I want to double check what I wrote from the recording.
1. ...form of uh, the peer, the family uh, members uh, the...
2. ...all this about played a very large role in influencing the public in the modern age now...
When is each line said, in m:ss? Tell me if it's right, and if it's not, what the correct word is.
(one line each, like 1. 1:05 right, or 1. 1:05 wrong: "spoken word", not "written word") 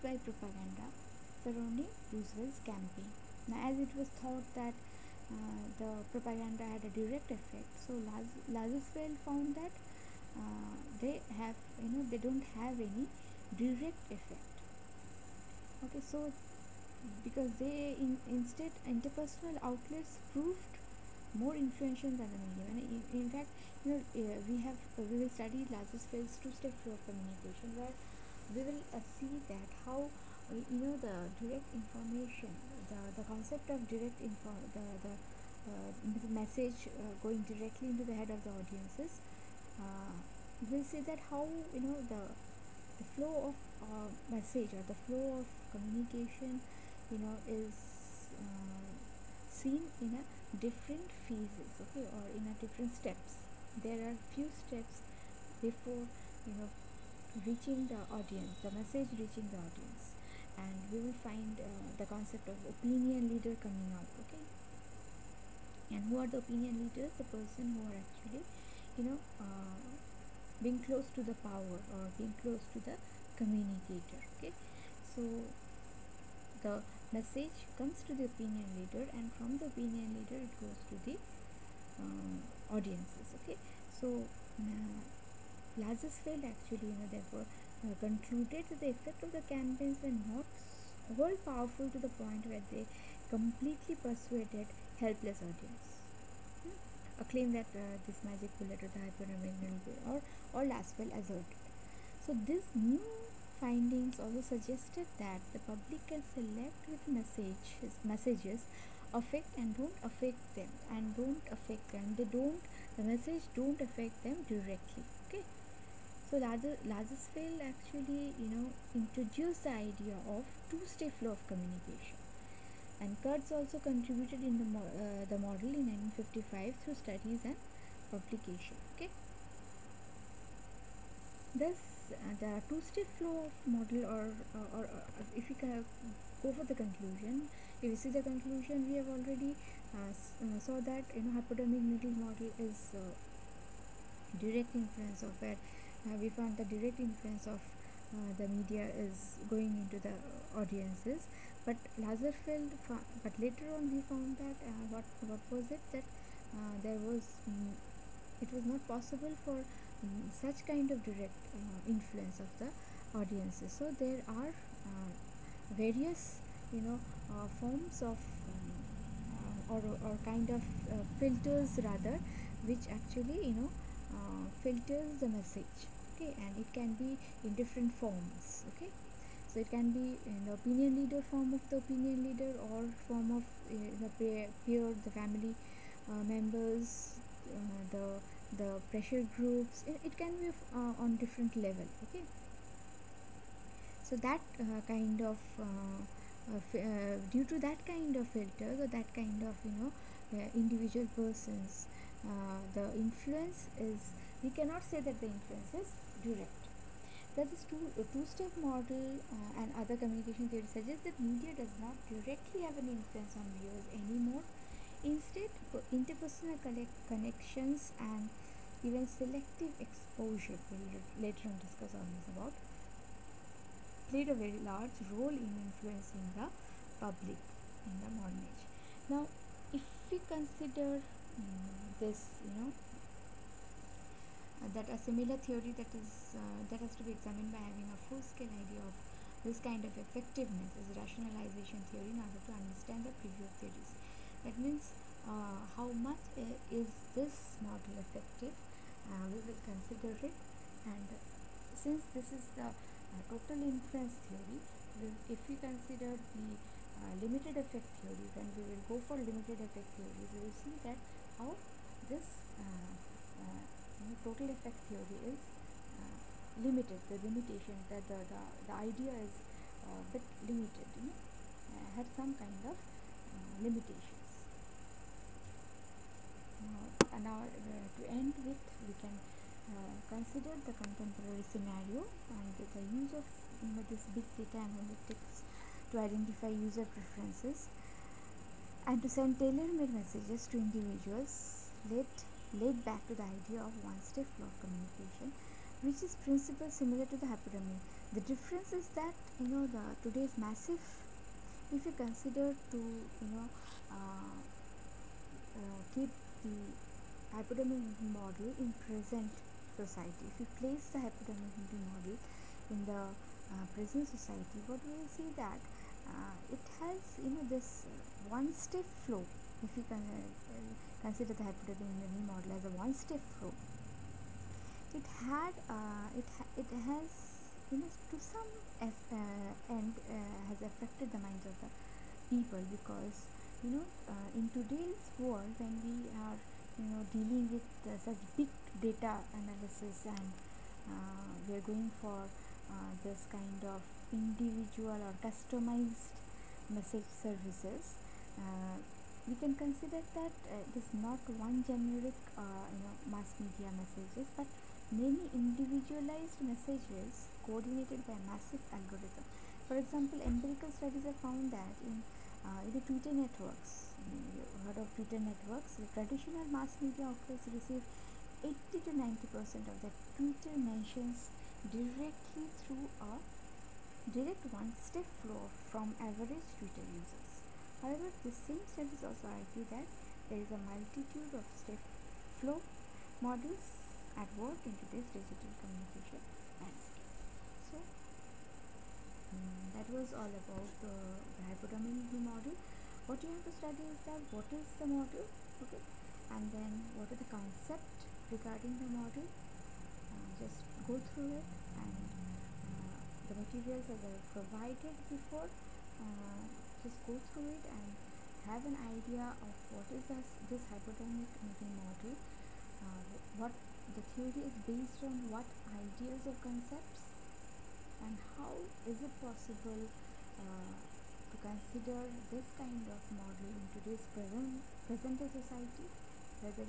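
1. 3:03 right
2. 3:42 right.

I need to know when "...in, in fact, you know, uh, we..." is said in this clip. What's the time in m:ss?
0:22.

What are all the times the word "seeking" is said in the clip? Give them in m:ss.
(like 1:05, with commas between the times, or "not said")
not said.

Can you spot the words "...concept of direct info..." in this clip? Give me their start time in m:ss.
0:33.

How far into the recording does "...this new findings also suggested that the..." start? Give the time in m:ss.
1:42.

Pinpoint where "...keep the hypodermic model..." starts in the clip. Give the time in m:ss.
5:05.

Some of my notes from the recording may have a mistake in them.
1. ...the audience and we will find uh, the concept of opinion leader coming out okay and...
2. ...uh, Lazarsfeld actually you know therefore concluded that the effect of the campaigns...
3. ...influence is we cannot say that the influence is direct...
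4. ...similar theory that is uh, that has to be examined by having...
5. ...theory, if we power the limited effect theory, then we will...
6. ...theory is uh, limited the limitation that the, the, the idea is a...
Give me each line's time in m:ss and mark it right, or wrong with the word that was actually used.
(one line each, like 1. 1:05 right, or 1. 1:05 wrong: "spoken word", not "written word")
1. 0:59 right
2. 1:24 right
3. 3:22 right
4. 3:54 right
5. 4:14 wrong: "consider", not "power"
6. 4:24 right.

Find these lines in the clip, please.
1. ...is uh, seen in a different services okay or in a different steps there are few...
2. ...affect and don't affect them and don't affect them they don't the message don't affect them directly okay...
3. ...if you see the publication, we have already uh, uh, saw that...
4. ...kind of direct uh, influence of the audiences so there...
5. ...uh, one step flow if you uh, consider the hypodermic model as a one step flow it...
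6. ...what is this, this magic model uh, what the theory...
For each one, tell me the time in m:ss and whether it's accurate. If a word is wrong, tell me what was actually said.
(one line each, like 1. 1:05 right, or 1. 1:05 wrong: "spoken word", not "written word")
1. 0:47 wrong: "phases", not "services"
2. 1:49 right
3. 2:17 wrong: "conclusion", not "publication"
4. 2:40 right
5. 5:17 right
6. 6:49 wrong: "hypodermic", not "magic".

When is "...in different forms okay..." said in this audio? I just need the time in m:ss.
2:57.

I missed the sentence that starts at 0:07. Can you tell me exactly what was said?
So Lazarsfeld found that uh, they have you know they don't have any direct effect.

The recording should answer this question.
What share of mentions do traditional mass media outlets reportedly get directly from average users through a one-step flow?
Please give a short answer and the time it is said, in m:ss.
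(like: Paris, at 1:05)
80 to 90 percent, at 6:08.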